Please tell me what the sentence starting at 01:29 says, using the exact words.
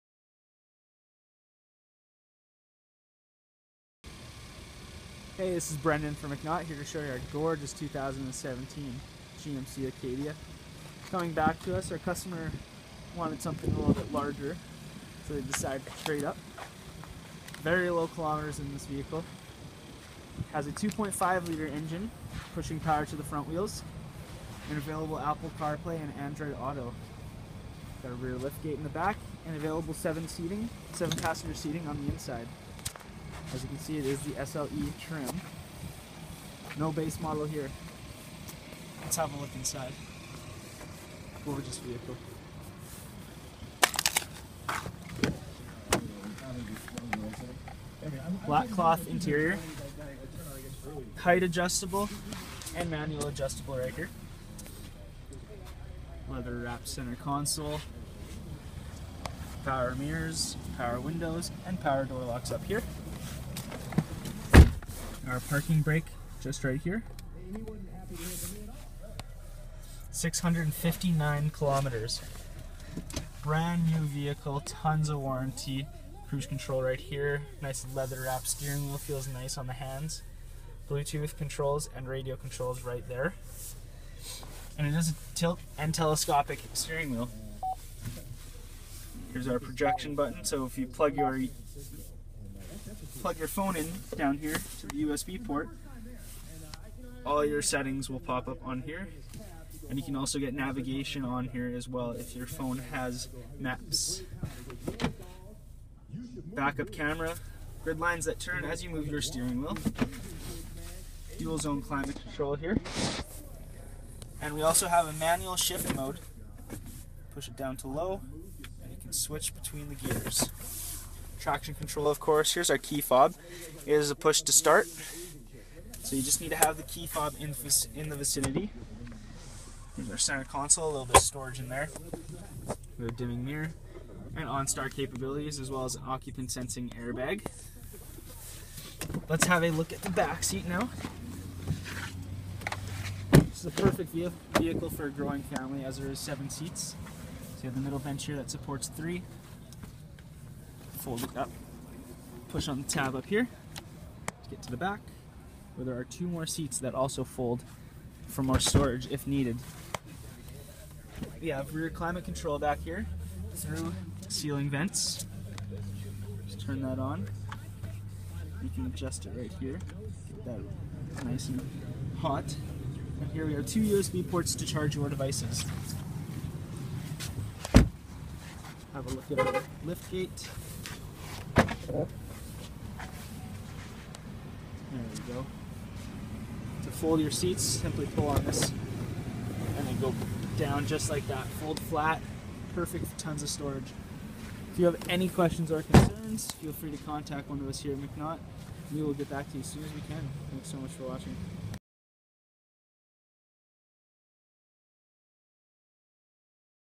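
Here's our projection button, so if you plug your plug your phone in down here to the USB port.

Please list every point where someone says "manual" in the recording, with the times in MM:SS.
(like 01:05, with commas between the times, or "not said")
00:52, 01:55.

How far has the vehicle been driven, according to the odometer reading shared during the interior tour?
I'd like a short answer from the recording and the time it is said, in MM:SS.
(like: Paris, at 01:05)
659 kilometers, at 01:10.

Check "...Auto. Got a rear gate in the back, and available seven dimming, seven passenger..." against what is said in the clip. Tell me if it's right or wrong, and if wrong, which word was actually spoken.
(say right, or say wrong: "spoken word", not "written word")
wrong: "seating", not "dimming".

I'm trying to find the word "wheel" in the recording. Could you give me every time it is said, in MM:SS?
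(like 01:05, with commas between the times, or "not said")
00:23, 01:18, 01:27, 01:49.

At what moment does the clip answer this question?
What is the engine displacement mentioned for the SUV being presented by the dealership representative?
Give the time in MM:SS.
00:20.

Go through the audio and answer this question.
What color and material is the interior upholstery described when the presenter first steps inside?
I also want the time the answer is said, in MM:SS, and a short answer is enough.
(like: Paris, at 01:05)
Black cloth, at 00:48.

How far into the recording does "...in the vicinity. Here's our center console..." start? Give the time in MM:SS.
02:07.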